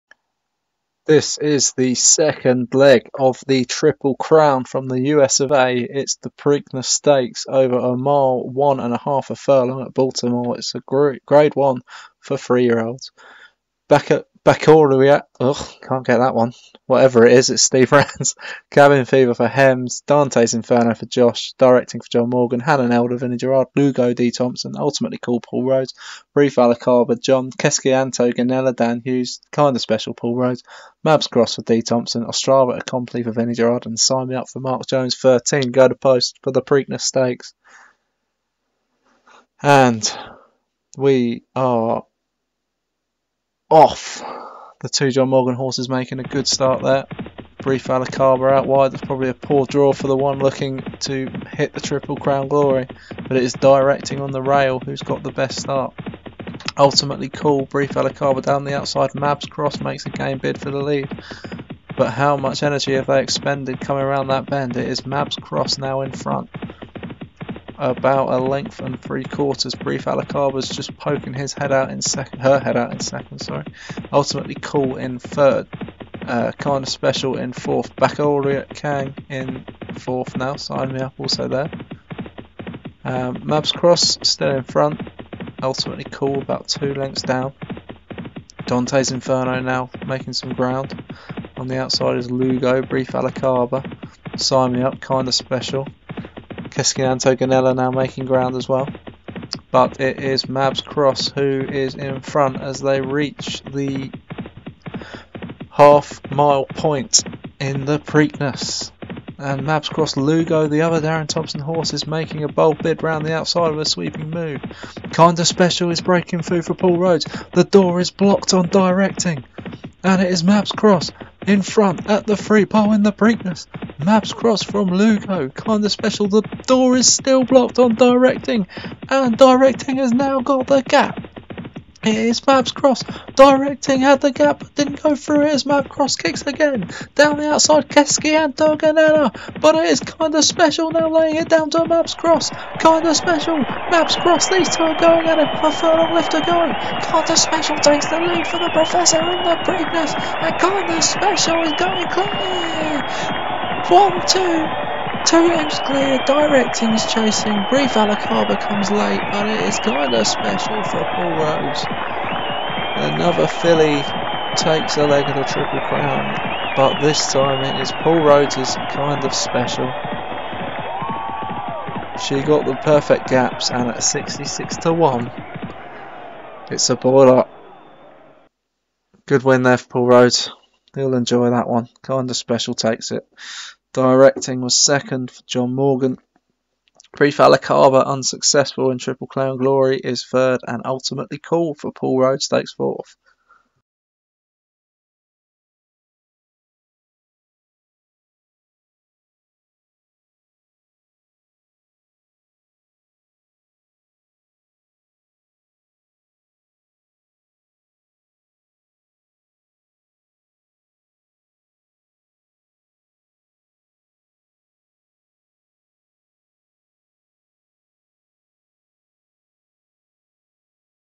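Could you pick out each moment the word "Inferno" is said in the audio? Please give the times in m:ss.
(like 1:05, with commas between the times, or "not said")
0:20, 1:29.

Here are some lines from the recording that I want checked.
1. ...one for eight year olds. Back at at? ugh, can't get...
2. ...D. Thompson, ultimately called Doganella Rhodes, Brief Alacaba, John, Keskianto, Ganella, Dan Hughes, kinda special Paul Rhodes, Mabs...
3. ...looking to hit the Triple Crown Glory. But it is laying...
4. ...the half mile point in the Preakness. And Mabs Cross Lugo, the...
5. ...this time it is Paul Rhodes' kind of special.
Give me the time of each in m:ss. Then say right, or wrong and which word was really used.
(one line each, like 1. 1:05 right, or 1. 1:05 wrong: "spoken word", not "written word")
1. 0:11 wrong: "three", not "eight"
2. 0:24 wrong: "Paul", not "Doganella"
3. 0:50 wrong: "directing", not "laying"
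4. 1:43 right
5. 2:47 right.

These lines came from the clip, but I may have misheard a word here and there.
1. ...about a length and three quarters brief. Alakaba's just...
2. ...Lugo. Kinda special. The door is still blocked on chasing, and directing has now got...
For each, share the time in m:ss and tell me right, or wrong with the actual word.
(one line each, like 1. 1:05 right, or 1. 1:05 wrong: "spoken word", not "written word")
1. 1:07 right
2. 2:04 wrong: "directing", not "chasing".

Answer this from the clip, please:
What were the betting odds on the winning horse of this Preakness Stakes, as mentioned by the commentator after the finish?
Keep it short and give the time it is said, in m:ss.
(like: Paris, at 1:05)
66 to 1, at 2:54.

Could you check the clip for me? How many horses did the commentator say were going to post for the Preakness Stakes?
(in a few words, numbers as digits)
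13.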